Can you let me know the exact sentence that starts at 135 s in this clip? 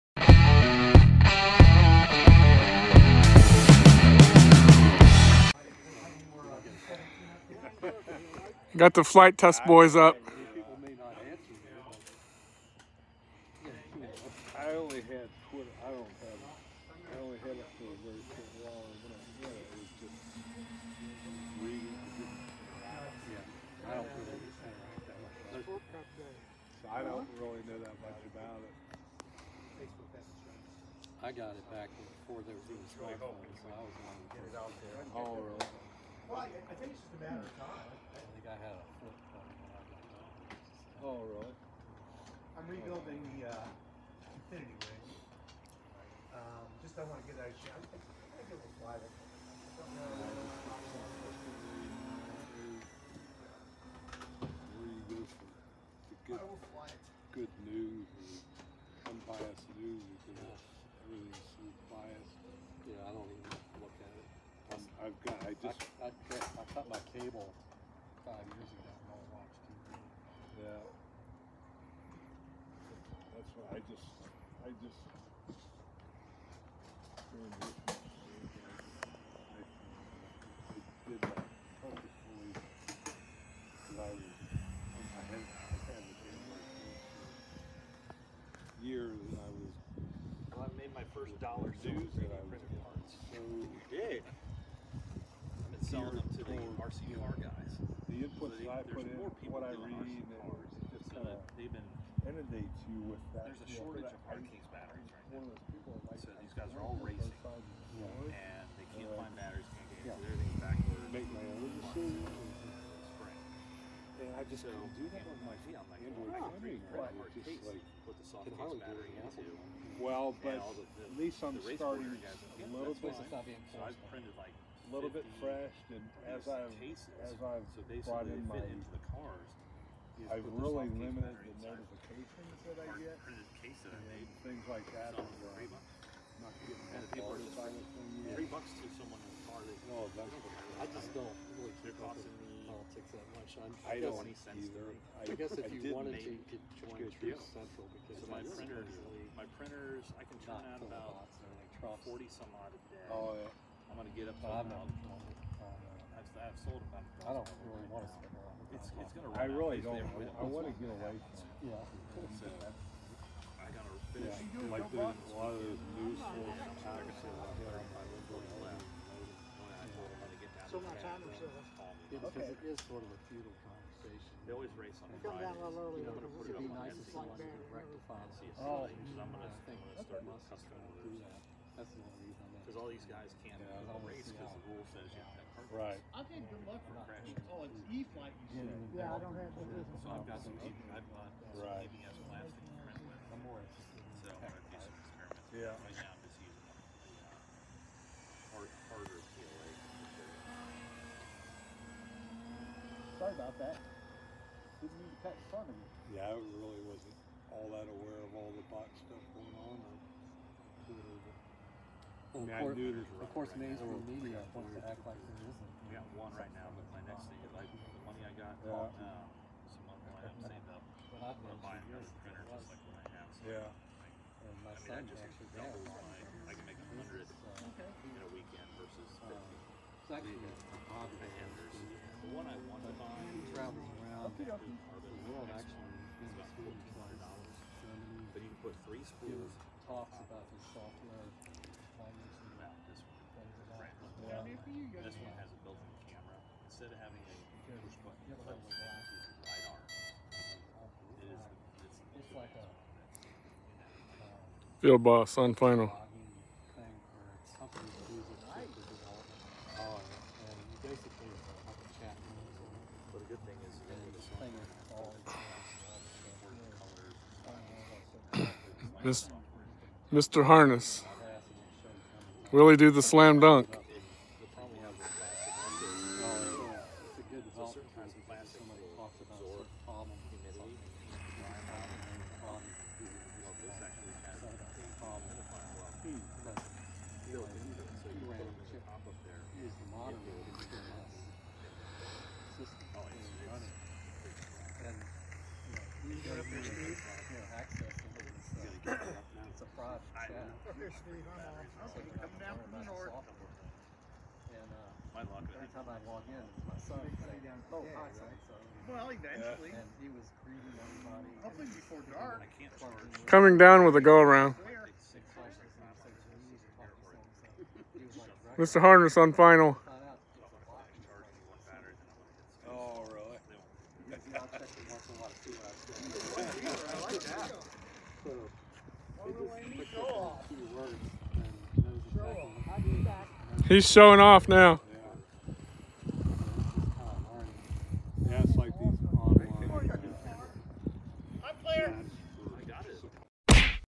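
And, uh, not getting and people are just three bucks to someone in the car.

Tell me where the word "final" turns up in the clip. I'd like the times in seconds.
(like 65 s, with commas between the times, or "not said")
255 s, 319 s.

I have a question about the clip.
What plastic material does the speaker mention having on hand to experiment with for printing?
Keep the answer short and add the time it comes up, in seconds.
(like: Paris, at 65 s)
ABS, at 191 s.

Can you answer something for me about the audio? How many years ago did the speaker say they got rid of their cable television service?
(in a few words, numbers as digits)
5.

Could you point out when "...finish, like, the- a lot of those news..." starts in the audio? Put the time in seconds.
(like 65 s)
164 s.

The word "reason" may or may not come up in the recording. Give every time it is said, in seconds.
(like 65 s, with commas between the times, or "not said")
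182 s.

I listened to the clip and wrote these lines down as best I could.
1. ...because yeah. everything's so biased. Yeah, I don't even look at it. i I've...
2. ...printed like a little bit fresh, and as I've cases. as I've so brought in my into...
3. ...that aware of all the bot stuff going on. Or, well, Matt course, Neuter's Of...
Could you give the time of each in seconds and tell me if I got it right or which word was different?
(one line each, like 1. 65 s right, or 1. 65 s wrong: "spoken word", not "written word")
1. 60 s right
2. 124 s right
3. 207 s right.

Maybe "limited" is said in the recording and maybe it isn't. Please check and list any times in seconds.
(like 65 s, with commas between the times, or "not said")
130 s.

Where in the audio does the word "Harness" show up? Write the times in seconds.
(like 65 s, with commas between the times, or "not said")
270 s, 318 s.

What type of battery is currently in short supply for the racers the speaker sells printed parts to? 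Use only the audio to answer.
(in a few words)
hard case batteries.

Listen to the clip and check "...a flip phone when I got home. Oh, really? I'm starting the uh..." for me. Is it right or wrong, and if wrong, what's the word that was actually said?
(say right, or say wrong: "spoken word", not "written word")
wrong: "rebuilding", not "starting".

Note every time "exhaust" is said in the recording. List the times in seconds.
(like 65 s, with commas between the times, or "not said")
not said.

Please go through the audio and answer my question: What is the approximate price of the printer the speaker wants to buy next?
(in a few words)
$1,400.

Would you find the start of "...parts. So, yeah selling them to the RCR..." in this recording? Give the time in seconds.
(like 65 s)
92 s.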